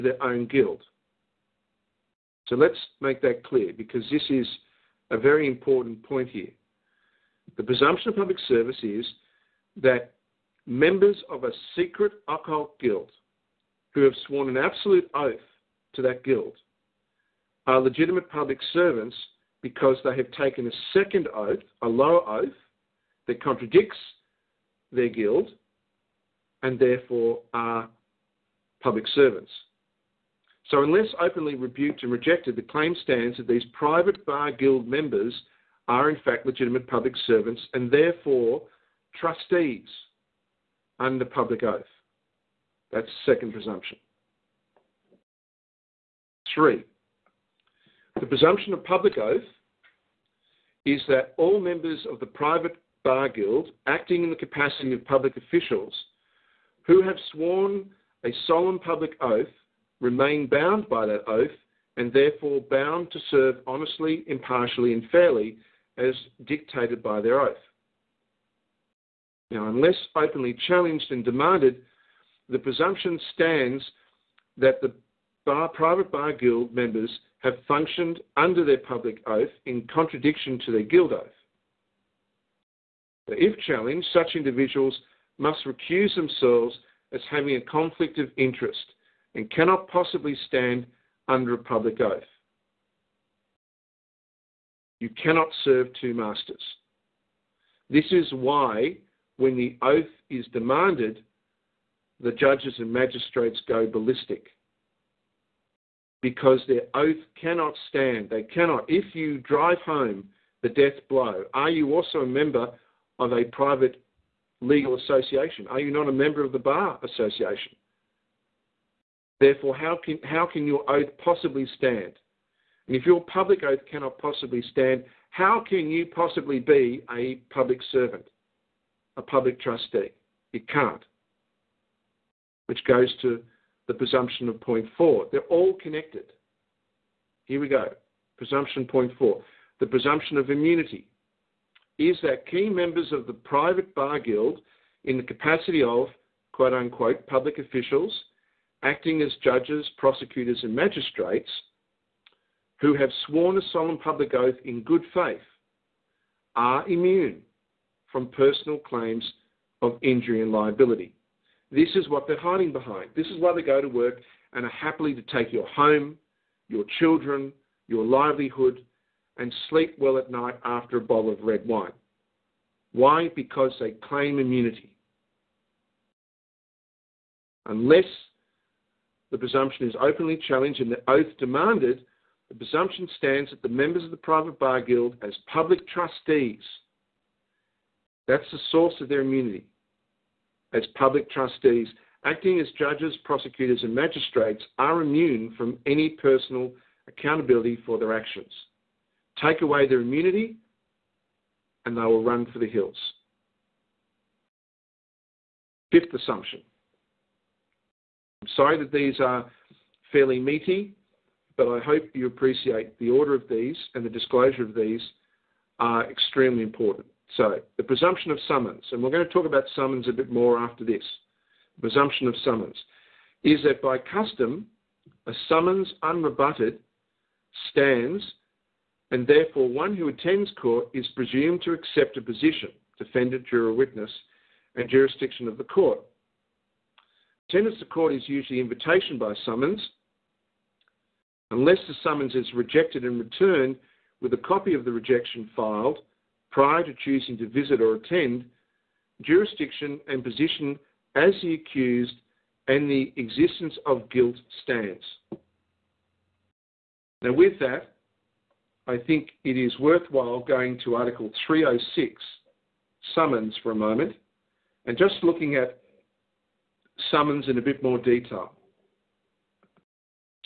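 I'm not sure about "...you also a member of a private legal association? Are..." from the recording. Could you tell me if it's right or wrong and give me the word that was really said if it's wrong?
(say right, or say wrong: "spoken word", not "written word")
right.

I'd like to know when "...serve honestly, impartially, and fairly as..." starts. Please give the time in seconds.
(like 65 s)
63 s.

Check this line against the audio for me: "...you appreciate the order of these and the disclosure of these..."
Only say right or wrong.
right.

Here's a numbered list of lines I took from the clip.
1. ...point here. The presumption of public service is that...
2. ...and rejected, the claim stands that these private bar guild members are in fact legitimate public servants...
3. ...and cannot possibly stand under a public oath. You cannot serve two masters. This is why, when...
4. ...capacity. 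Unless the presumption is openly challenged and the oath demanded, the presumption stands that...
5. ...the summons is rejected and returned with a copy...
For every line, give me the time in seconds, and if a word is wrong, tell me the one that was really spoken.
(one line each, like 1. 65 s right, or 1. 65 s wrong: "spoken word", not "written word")
1. 6 s right
2. 32 s right
3. 89 s right
4. 174 s wrong: "immunity", not "capacity"
5. 241 s right.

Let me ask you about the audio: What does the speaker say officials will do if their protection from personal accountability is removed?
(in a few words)
run for the hills.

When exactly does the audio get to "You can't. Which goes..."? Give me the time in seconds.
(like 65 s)
130 s.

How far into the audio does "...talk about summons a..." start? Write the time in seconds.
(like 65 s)
219 s.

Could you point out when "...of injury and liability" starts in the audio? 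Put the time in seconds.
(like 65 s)
159 s.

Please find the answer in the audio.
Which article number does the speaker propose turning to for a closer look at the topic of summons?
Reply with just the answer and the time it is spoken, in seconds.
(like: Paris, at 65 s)
306, at 261 s.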